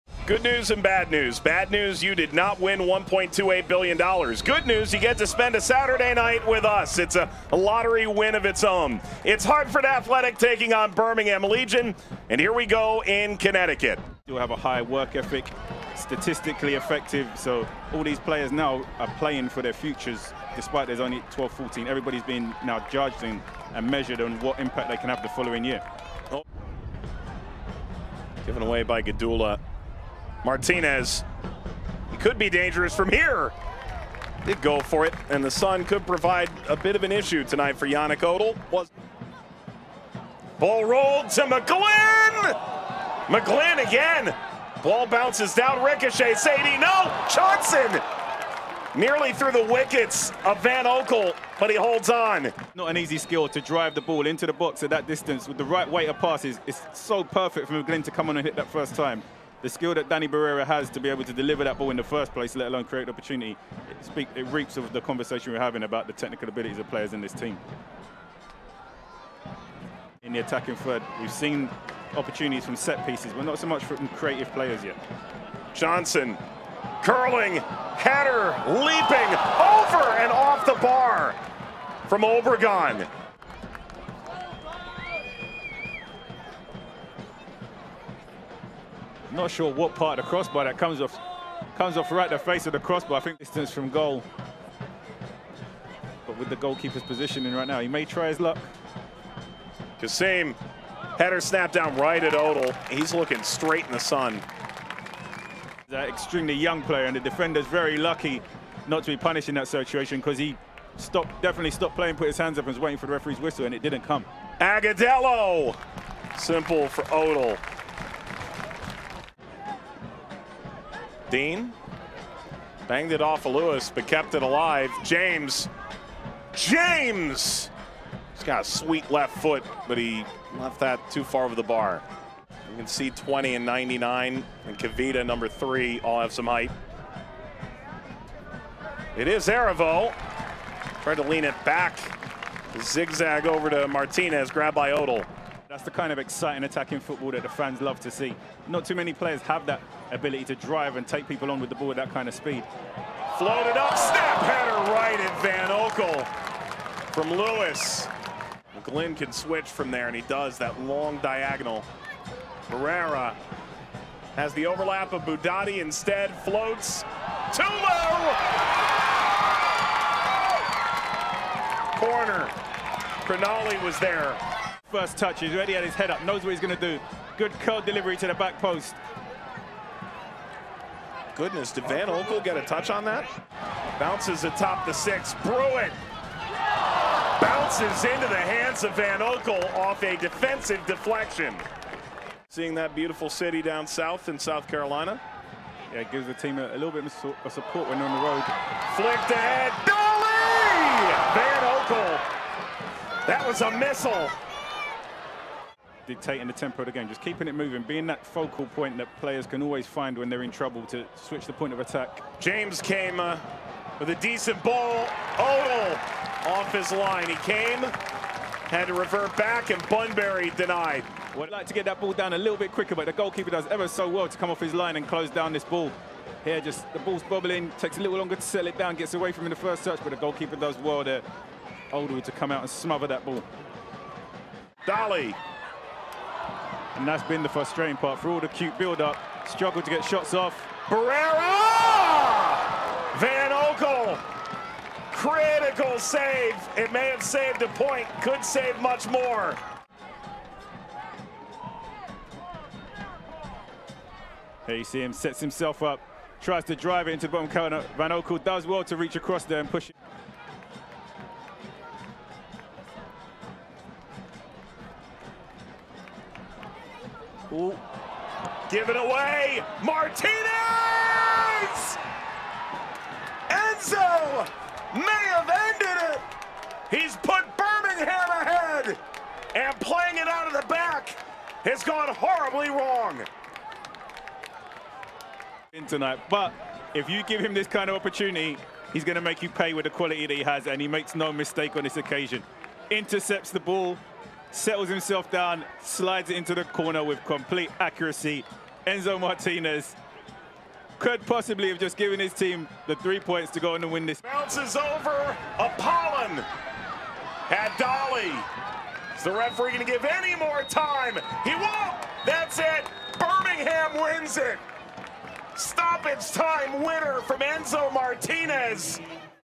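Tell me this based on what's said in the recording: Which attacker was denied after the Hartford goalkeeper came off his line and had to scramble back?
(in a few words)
Bunbury.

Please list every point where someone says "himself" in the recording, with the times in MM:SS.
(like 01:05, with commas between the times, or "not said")
04:15, 04:54.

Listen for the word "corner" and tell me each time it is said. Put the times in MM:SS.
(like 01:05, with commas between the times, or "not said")
02:51, 04:17, 04:56.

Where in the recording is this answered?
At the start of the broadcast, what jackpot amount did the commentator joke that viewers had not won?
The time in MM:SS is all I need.
00:02.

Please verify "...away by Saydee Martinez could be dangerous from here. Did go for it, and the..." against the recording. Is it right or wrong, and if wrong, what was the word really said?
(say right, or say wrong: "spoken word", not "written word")
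wrong: "Gadula", not "Saydee".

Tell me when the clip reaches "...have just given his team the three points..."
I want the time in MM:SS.
05:01.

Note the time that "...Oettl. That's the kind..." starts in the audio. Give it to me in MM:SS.
02:24.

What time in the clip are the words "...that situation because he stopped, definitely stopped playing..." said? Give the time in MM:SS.
01:49.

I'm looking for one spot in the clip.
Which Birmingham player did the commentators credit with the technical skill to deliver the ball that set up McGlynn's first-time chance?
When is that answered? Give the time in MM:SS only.
01:00.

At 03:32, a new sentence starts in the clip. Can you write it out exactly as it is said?
James came uh, with a decent ball.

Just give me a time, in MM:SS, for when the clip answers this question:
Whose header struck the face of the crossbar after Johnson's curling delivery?
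01:22.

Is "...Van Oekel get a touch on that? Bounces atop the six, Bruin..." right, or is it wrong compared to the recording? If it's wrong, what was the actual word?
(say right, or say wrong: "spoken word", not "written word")
right.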